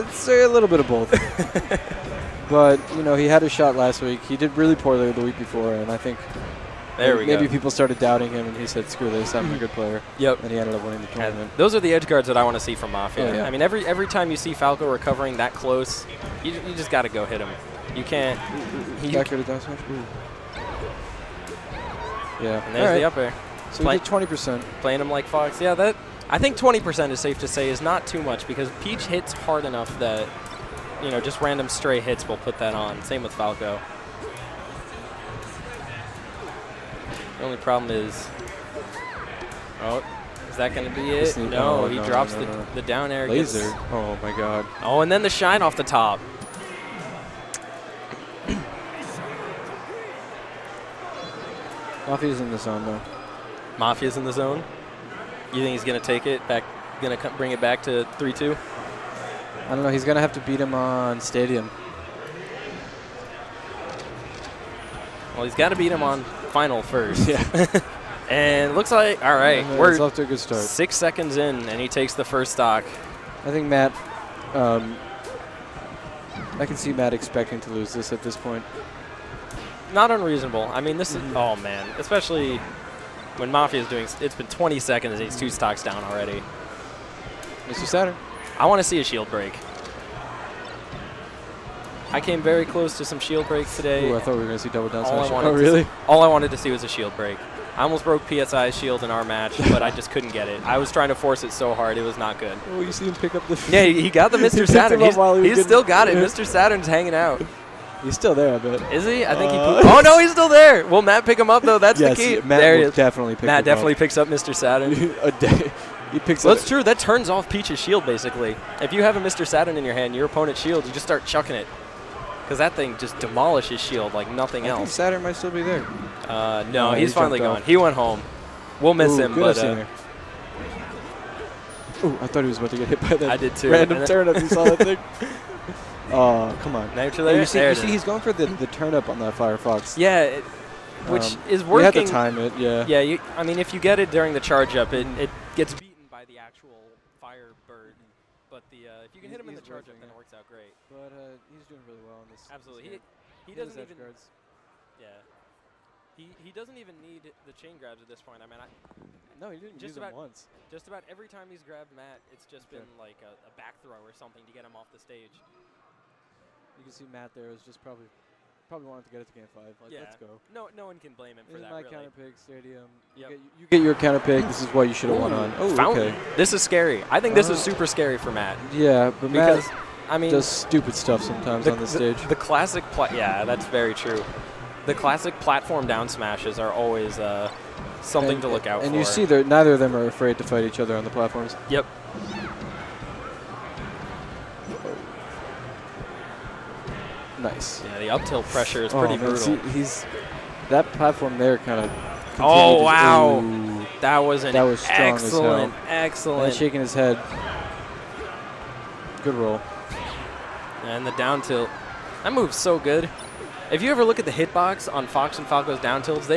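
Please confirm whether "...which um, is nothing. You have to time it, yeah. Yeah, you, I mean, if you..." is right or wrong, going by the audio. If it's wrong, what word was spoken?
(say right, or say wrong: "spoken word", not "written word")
wrong: "working", not "nothing".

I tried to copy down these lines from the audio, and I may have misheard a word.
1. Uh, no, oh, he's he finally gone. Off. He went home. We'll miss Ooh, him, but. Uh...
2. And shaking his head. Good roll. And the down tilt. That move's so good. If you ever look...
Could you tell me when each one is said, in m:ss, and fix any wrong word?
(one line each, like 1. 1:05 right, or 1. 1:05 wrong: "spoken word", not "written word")
1. 2:06 right
2. 3:26 right.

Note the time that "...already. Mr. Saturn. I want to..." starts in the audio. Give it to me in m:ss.
1:26.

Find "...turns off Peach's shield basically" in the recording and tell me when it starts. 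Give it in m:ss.
1:56.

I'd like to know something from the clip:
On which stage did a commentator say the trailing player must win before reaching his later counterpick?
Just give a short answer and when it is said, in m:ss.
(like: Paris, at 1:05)
Final, at 1:06.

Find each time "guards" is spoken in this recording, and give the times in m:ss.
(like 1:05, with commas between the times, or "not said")
0:12, 2:33.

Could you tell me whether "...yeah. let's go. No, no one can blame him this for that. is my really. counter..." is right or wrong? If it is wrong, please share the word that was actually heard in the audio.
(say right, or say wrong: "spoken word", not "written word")
right.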